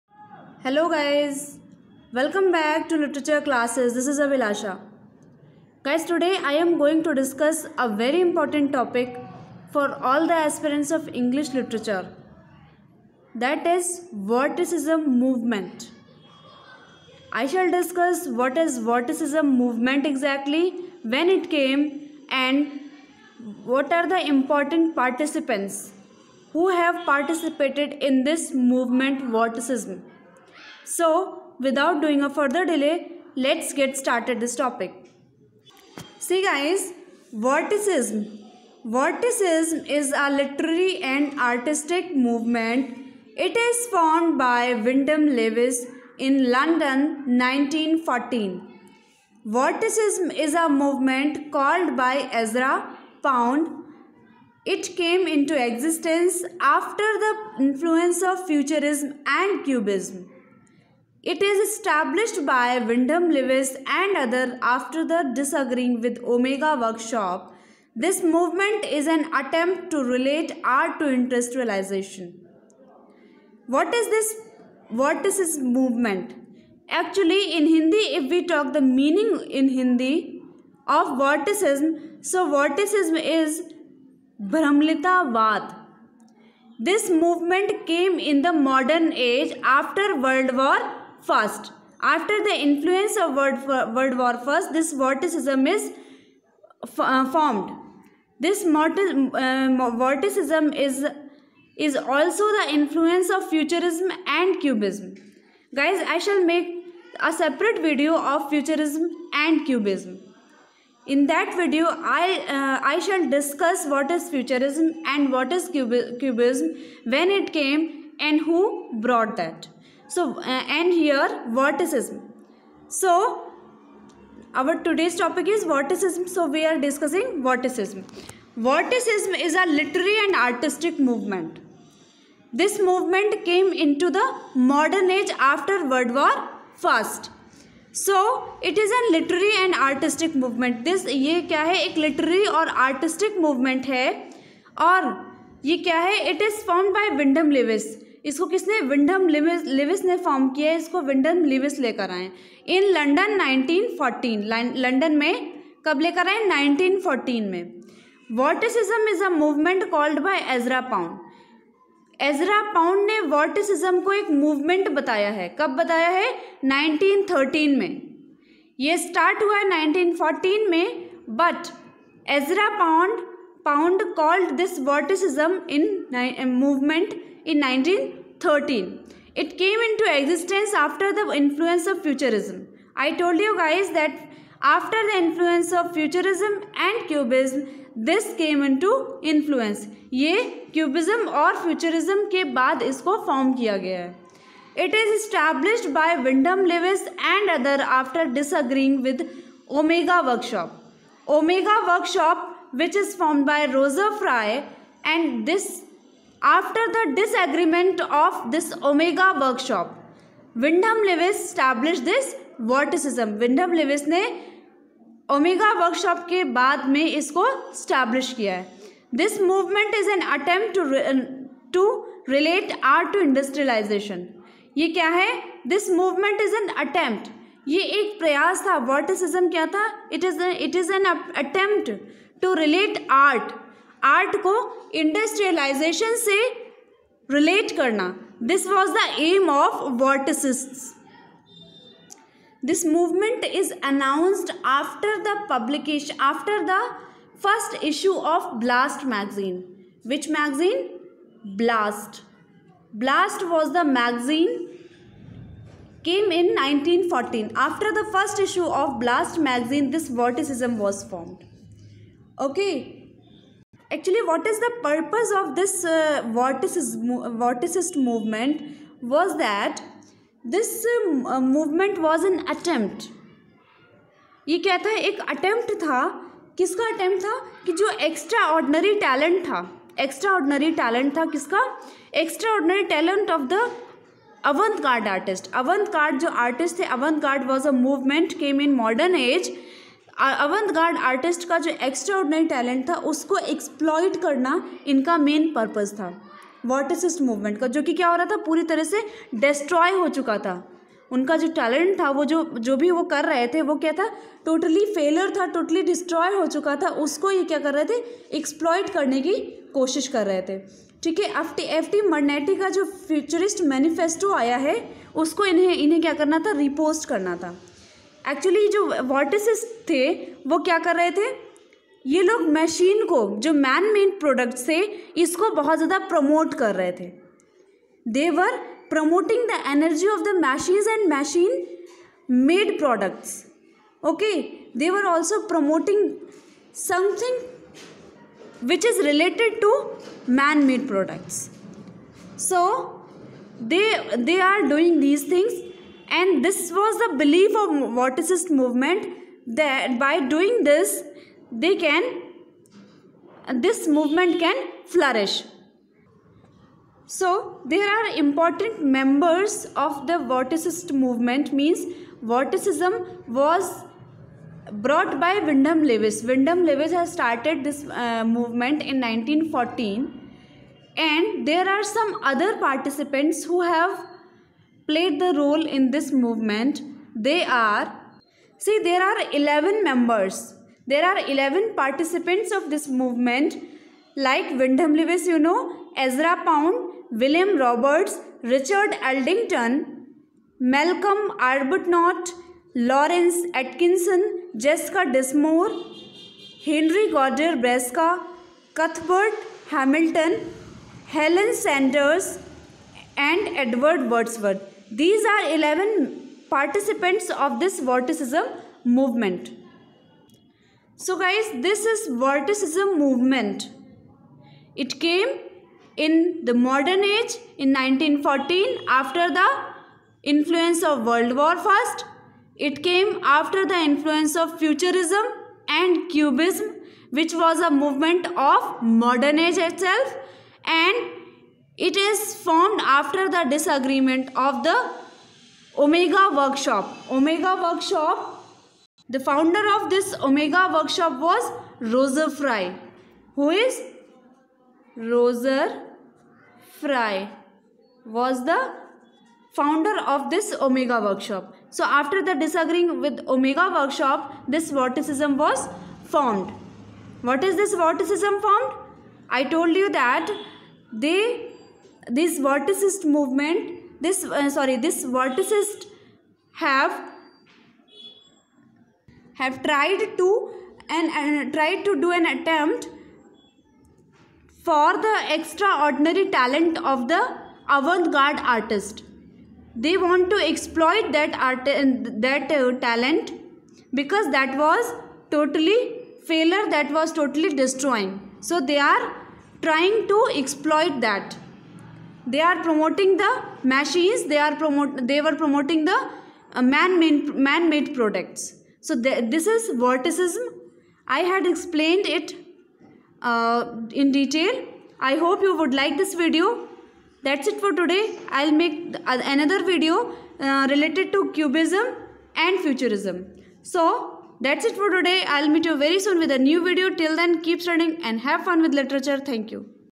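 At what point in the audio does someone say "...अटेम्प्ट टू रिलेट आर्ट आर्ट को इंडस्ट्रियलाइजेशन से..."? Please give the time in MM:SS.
03:51.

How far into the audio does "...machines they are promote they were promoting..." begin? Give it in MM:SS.
08:13.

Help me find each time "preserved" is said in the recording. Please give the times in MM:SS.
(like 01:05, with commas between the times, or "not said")
not said.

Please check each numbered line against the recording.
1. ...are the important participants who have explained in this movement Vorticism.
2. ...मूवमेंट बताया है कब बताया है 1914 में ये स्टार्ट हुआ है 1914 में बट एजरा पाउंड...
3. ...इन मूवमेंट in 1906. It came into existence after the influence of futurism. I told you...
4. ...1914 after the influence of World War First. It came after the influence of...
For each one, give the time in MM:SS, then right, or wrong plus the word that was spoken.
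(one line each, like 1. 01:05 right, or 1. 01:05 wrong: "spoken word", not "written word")
1. 00:23 wrong: "participated", not "explained"
2. 02:44 wrong: "1913", not "1914"
3. 02:55 wrong: "1913", not "1906"
4. 06:57 right.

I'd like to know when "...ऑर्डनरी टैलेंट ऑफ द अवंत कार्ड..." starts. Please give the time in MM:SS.
04:42.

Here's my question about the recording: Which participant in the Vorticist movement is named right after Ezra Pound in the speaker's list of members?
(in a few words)
William Roberts.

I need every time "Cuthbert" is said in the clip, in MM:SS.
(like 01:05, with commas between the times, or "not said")
06:38.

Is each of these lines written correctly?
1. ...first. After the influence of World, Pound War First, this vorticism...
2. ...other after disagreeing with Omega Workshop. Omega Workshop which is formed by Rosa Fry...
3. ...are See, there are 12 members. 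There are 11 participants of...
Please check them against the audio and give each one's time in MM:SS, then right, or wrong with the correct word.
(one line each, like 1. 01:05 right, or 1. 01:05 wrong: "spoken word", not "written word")
1. 01:31 wrong: "World", not "Pound"
2. 03:17 right
3. 06:17 wrong: "11", not "12".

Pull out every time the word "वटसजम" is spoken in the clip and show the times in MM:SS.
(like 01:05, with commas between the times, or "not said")
02:38, 02:43, 02:54.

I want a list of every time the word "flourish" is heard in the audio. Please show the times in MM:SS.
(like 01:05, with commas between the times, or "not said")
05:54.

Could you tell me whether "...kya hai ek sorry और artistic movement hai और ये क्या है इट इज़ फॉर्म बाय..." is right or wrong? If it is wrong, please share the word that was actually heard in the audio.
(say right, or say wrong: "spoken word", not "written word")
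wrong: "literary", not "sorry".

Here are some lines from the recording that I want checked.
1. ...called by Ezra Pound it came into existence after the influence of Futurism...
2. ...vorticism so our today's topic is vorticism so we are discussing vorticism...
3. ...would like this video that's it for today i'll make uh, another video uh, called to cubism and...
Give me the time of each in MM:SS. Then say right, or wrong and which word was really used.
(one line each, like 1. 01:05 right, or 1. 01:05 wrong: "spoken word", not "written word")
1. 00:51 right
2. 02:01 right
3. 08:25 wrong: "related", not "called".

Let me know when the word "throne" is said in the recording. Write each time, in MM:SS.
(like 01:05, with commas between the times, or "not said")
not said.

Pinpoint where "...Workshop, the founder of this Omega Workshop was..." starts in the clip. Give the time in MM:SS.
07:17.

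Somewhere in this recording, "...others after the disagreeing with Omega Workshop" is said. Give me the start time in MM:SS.
01:04.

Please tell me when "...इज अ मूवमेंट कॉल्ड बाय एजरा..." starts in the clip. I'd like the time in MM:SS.
02:39.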